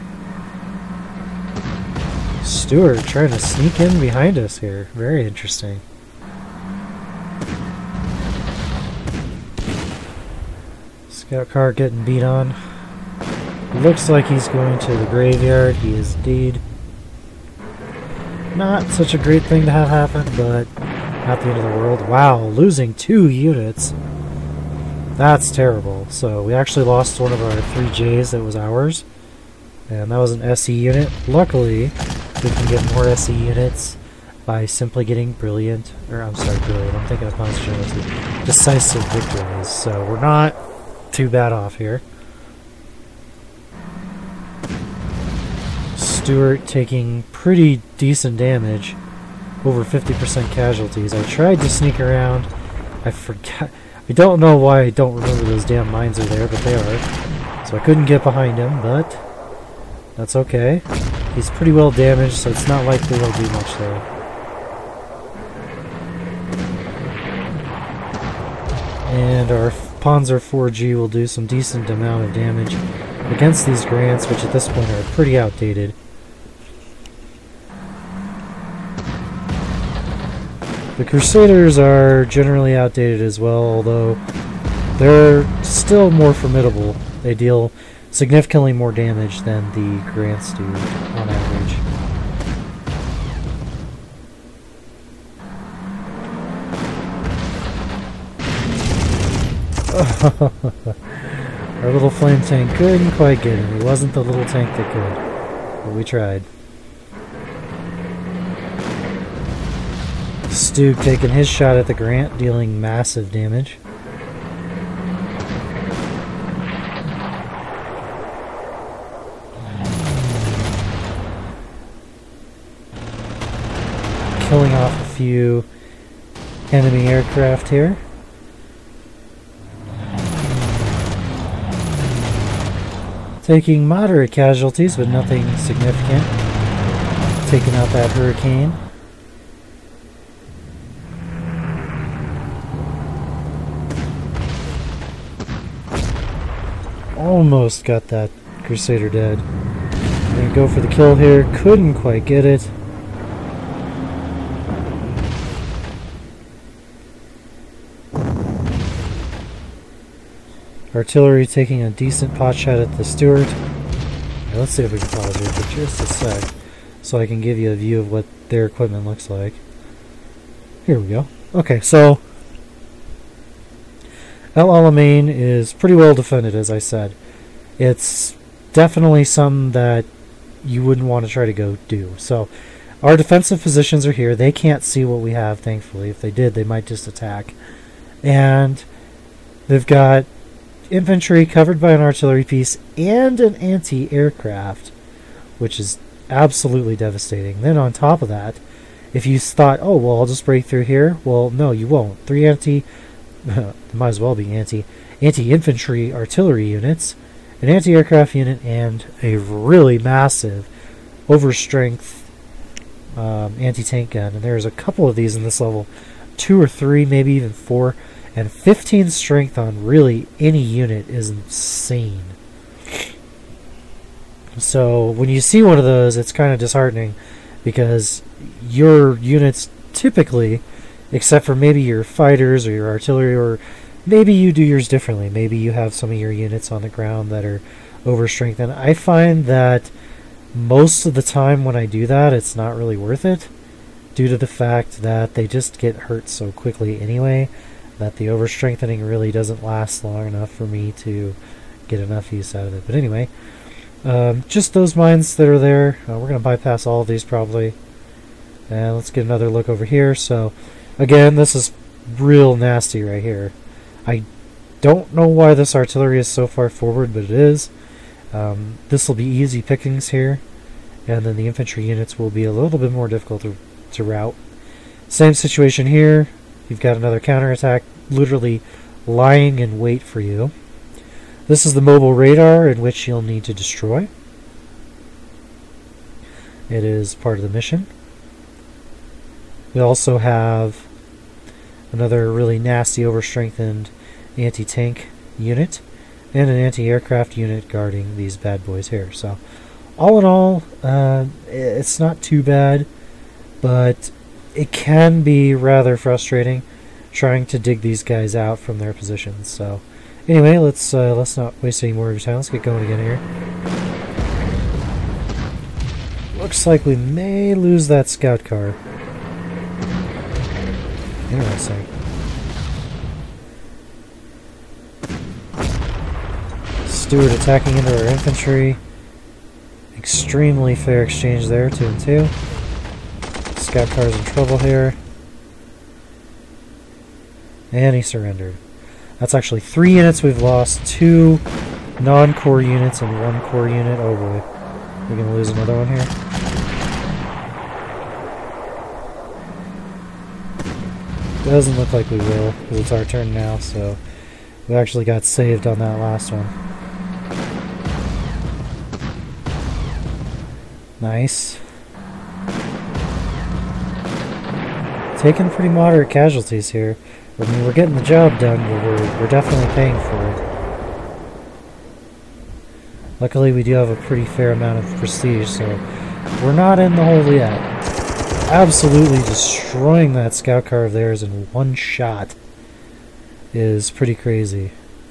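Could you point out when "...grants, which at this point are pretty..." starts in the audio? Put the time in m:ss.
1:13.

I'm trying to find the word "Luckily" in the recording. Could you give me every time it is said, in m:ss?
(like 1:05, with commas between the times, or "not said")
0:31, 6:13.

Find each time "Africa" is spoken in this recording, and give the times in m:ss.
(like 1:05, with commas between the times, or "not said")
not said.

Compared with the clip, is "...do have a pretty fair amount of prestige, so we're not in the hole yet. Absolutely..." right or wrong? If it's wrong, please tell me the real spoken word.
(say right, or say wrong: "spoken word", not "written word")
right.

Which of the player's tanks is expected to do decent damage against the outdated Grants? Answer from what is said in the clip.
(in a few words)
Panzer 4G.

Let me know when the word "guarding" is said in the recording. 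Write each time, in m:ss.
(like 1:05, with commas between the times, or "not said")
4:57.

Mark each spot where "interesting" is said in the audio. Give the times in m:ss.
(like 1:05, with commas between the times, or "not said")
0:05, 5:21.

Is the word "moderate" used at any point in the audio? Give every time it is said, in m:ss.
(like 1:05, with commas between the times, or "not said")
2:13, 6:05.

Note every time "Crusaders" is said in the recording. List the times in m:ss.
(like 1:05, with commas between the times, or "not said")
1:21, 2:28.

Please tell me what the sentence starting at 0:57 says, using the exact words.
So I couldn't get behind him, but that's okay.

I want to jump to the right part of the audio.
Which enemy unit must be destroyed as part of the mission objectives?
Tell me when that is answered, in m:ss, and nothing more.
4:41.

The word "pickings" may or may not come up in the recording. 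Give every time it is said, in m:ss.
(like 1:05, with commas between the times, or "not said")
4:29.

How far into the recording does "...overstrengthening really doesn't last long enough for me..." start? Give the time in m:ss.
4:08.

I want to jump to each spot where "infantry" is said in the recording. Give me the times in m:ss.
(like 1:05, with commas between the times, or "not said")
3:10, 3:25, 4:31, 5:28.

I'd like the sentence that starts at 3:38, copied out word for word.
And 15 strength on really any unit is insane.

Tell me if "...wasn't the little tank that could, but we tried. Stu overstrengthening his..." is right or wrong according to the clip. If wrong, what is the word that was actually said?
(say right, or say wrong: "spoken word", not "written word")
wrong: "taking", not "overstrengthening".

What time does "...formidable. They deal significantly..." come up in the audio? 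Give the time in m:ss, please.
1:26.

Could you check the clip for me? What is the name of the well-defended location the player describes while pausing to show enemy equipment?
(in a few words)
El Alamein.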